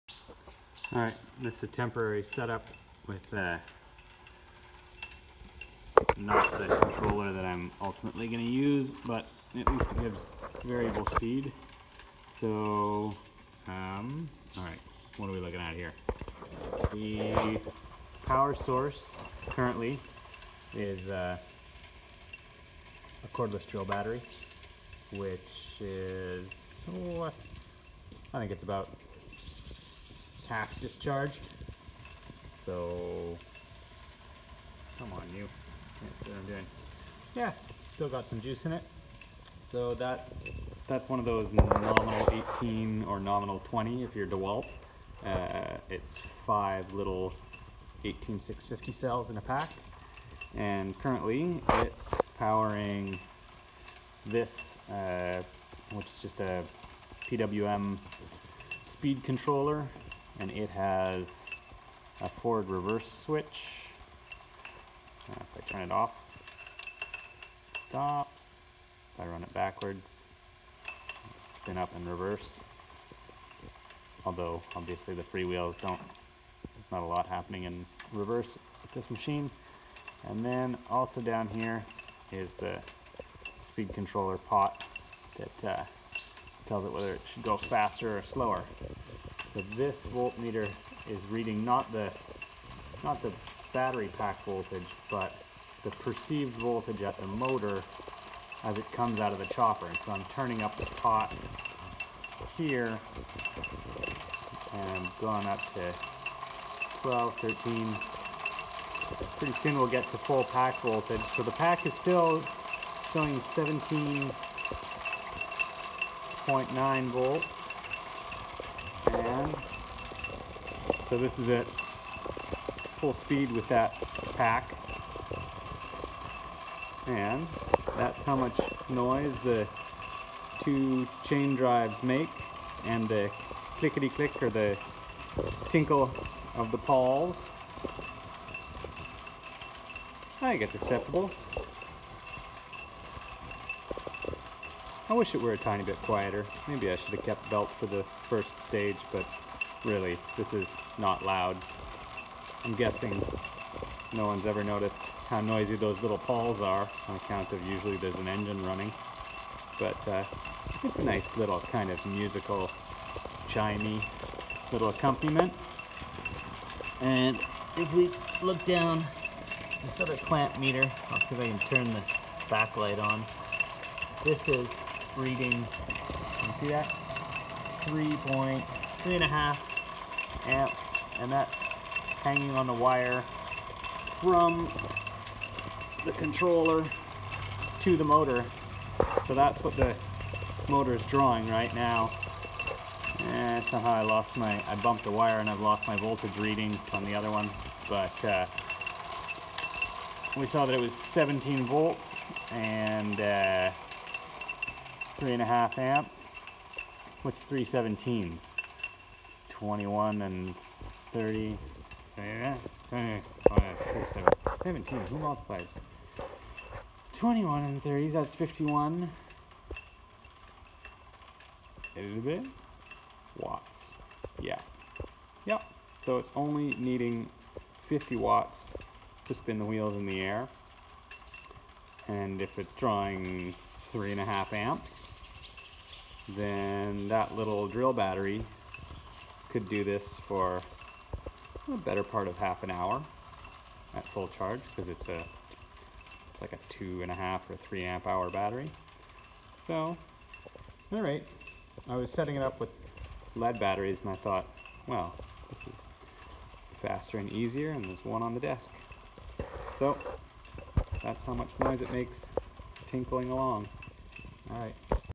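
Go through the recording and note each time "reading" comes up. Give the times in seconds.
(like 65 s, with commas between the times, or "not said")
91 s, 175 s, 196 s.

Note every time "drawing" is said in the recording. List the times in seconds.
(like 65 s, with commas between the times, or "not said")
191 s, 232 s.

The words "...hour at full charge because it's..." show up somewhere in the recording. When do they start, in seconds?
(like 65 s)
242 s.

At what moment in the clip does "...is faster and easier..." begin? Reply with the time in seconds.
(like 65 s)
255 s.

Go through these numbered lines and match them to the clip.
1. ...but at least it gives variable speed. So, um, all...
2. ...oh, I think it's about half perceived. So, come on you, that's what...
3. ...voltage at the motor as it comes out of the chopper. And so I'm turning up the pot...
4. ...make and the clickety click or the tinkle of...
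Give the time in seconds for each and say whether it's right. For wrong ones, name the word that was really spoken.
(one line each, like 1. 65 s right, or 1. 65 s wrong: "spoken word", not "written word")
1. 9 s right
2. 27 s wrong: "discharged", not "perceived"
3. 96 s right
4. 132 s right.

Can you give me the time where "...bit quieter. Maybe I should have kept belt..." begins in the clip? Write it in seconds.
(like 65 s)
145 s.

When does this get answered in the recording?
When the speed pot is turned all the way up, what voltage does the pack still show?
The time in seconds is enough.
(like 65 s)
113 s.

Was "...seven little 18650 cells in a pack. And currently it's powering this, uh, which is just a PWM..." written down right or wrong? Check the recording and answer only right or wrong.
wrong.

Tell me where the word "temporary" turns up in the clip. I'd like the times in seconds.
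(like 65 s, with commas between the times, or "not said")
1 s.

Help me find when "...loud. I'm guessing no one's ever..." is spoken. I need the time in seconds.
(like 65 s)
151 s.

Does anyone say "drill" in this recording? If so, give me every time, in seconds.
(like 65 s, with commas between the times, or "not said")
23 s, 237 s.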